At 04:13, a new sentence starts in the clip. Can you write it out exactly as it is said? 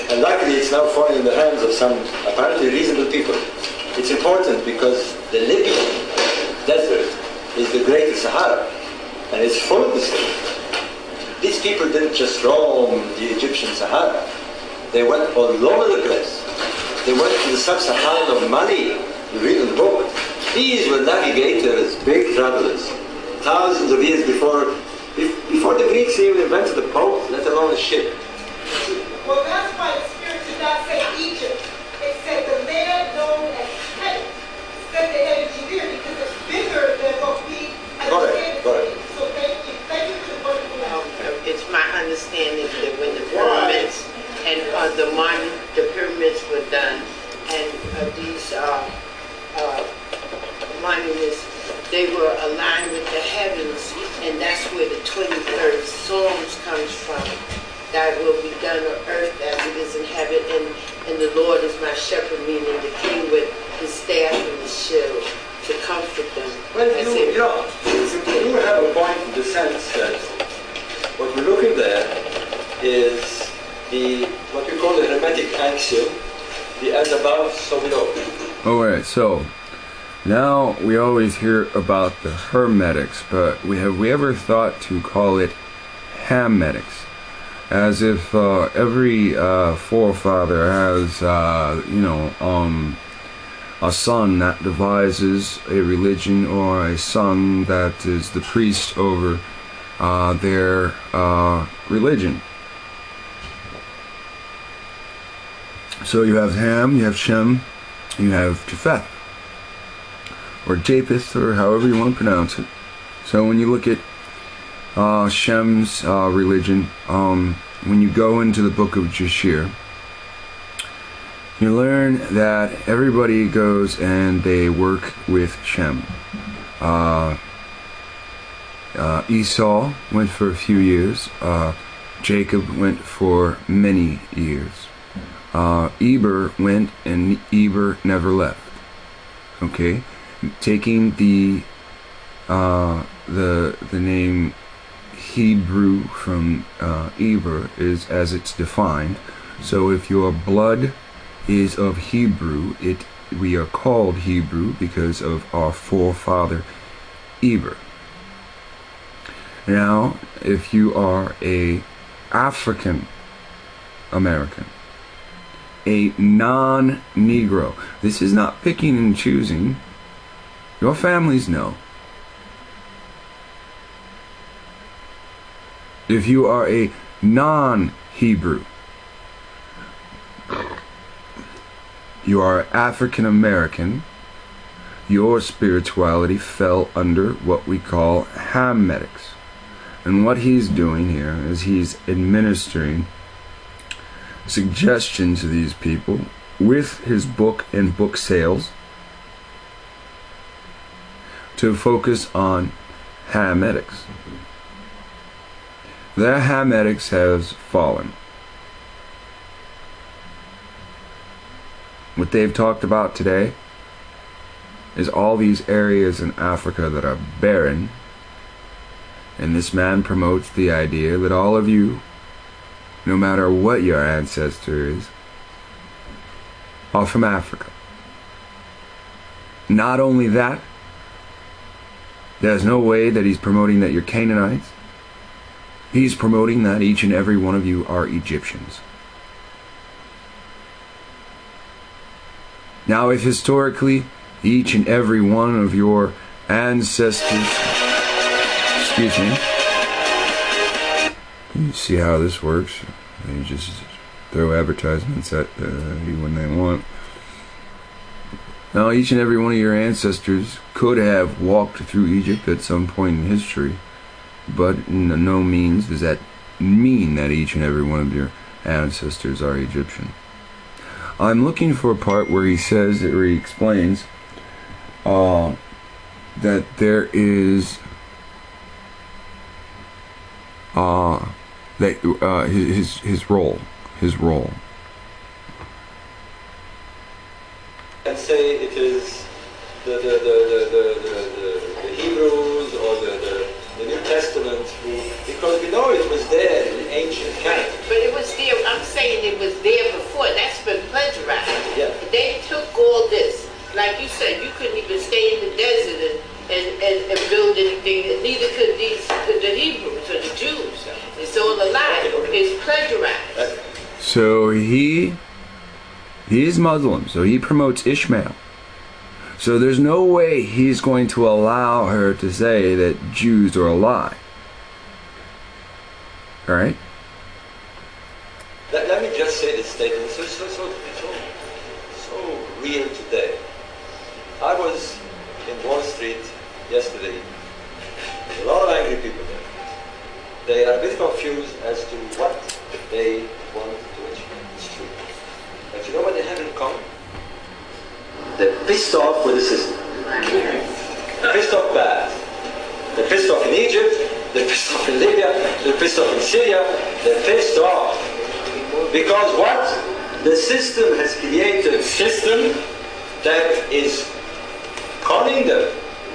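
You just throw advertisements at uh, you when they want.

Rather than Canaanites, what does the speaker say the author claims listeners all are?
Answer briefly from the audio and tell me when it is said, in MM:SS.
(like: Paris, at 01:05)
Egyptians, at 03:58.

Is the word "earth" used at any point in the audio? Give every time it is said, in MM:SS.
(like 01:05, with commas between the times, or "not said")
00:59.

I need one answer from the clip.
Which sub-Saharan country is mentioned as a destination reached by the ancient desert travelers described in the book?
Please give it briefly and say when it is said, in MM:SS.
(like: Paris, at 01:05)
Mali, at 00:18.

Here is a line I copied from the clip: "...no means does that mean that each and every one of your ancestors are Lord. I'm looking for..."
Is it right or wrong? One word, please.
wrong.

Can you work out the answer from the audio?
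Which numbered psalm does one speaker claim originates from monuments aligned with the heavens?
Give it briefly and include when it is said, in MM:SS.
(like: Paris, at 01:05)
23rd Psalm, at 00:55.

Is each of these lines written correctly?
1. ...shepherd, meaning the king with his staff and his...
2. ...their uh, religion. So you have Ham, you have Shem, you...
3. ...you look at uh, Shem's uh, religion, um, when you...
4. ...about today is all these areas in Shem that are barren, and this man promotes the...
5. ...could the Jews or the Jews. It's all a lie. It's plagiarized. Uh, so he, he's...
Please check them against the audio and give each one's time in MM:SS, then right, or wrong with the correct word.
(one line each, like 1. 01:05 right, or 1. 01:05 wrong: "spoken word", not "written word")
1. 01:01 right
2. 01:40 right
3. 01:53 right
4. 03:32 wrong: "Africa", not "Shem"
5. 05:09 wrong: "Hebrews", not "Jews".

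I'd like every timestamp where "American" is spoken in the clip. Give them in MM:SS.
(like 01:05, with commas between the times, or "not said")
02:44, 03:03.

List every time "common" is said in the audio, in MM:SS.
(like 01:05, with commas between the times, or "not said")
05:46.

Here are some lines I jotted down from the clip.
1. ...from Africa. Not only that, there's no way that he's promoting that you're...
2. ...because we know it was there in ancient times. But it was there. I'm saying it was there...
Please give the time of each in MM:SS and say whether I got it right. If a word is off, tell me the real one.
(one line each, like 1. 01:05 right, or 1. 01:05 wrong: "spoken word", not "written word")
1. 03:47 right
2. 04:55 right.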